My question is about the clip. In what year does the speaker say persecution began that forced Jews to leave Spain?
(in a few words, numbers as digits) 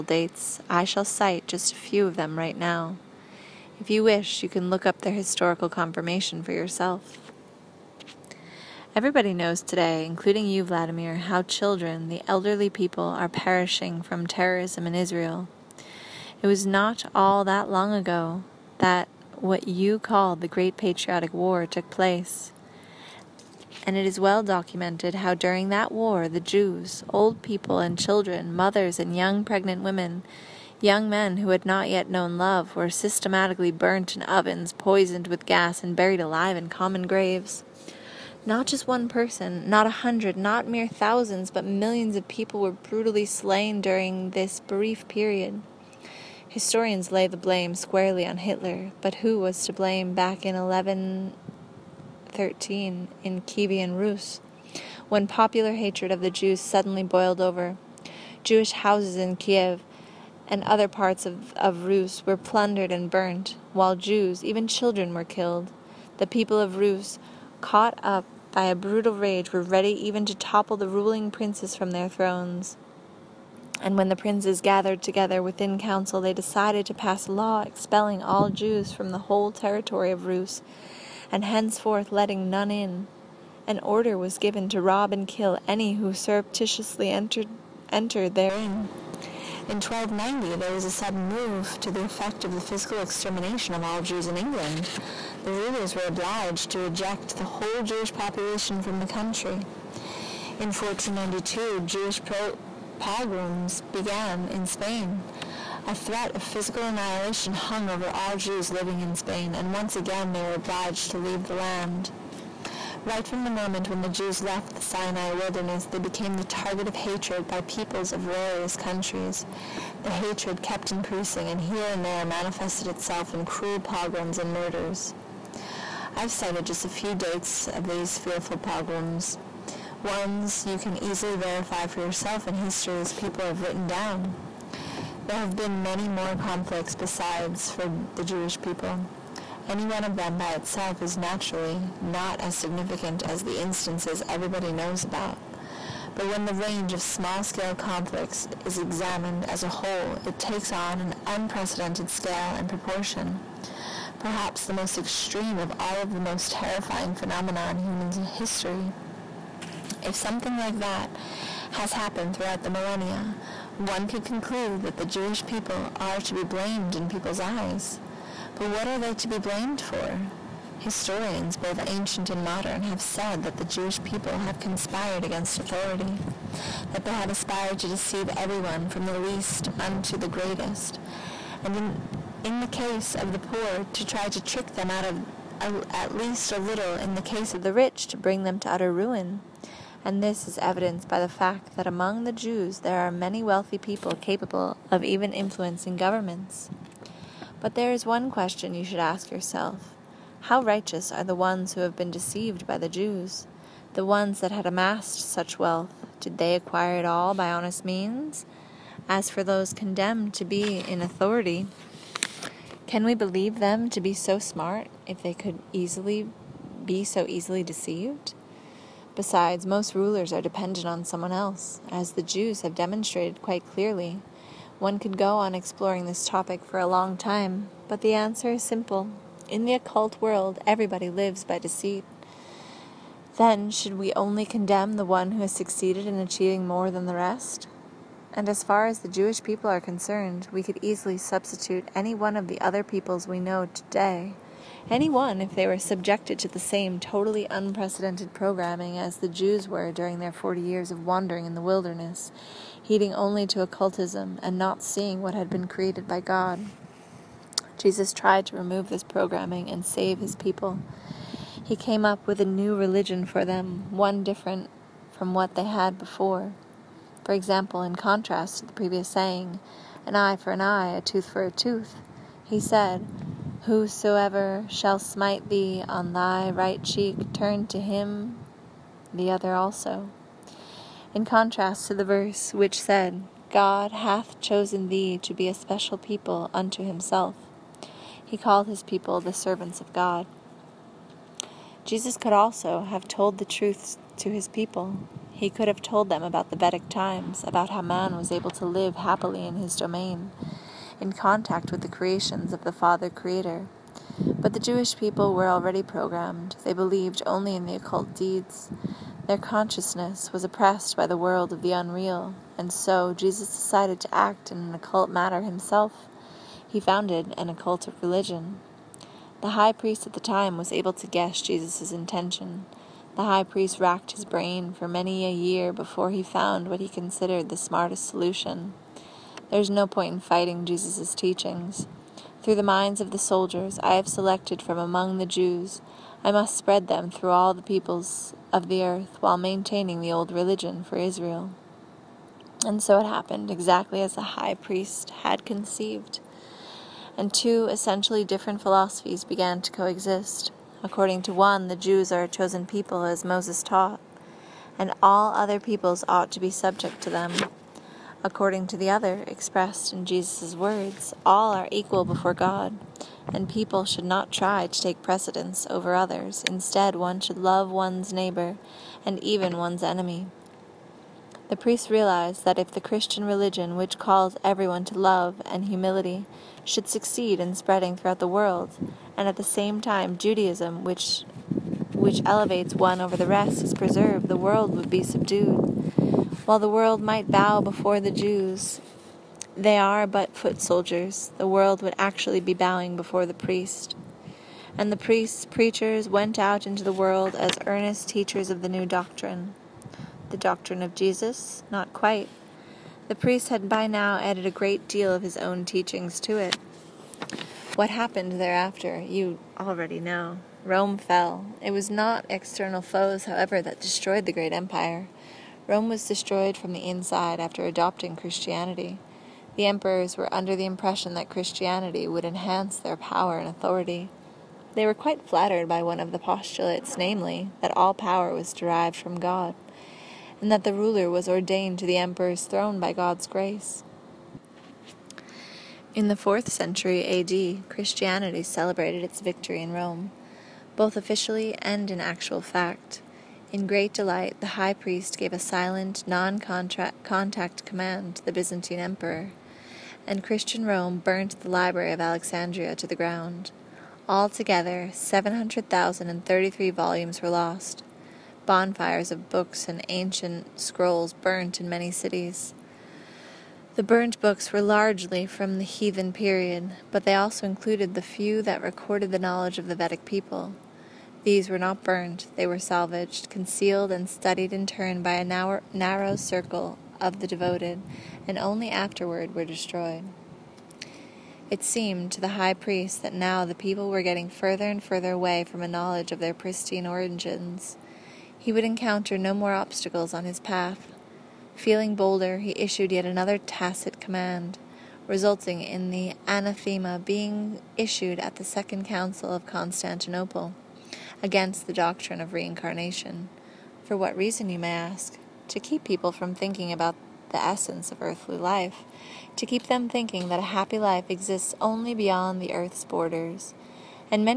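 1492.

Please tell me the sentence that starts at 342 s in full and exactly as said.
And so it happened, exactly as the high priest had conceived.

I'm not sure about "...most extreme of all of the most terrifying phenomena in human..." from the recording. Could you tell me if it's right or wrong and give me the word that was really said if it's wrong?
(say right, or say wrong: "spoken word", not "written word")
right.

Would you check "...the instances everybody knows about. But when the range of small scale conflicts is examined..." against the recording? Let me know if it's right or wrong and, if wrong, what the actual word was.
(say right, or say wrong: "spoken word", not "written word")
right.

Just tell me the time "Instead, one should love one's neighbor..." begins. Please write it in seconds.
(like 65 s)
366 s.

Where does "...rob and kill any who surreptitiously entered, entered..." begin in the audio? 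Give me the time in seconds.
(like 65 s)
84 s.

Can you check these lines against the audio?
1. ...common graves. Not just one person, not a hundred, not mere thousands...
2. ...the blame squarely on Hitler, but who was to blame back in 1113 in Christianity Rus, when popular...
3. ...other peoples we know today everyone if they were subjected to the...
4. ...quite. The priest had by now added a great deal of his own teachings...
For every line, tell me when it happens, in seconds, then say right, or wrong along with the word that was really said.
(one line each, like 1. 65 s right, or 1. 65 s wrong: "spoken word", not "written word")
1. 36 s right
2. 47 s wrong: "Kievan", not "Christianity"
3. 242 s wrong: "anyone", not "everyone"
4. 401 s right.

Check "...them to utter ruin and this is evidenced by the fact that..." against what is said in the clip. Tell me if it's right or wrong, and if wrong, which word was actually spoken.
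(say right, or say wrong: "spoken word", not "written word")
right.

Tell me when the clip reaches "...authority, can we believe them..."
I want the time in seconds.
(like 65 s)
211 s.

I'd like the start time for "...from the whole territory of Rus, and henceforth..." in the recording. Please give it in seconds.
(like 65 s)
78 s.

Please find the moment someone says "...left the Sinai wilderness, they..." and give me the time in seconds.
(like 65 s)
114 s.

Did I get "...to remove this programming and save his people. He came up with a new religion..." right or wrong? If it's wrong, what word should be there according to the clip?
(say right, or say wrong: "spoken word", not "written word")
right.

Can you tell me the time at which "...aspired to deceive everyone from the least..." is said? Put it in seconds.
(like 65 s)
177 s.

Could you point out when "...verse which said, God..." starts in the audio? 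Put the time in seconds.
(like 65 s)
282 s.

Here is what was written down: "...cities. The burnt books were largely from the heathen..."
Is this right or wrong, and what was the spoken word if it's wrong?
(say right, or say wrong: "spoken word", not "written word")
right.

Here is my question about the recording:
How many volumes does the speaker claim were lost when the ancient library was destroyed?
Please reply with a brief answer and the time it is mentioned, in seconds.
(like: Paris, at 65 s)
700,033, at 454 s.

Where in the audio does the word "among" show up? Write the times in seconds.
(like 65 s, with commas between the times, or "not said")
191 s, 334 s.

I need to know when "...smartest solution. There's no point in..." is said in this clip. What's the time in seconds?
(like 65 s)
327 s.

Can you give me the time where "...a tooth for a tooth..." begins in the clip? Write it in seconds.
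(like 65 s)
270 s.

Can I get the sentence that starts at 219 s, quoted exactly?
Besides, most rulers are dependent on someone else, as the Jews have demonstrated quite clearly.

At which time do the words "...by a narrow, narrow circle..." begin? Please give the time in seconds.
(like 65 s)
475 s.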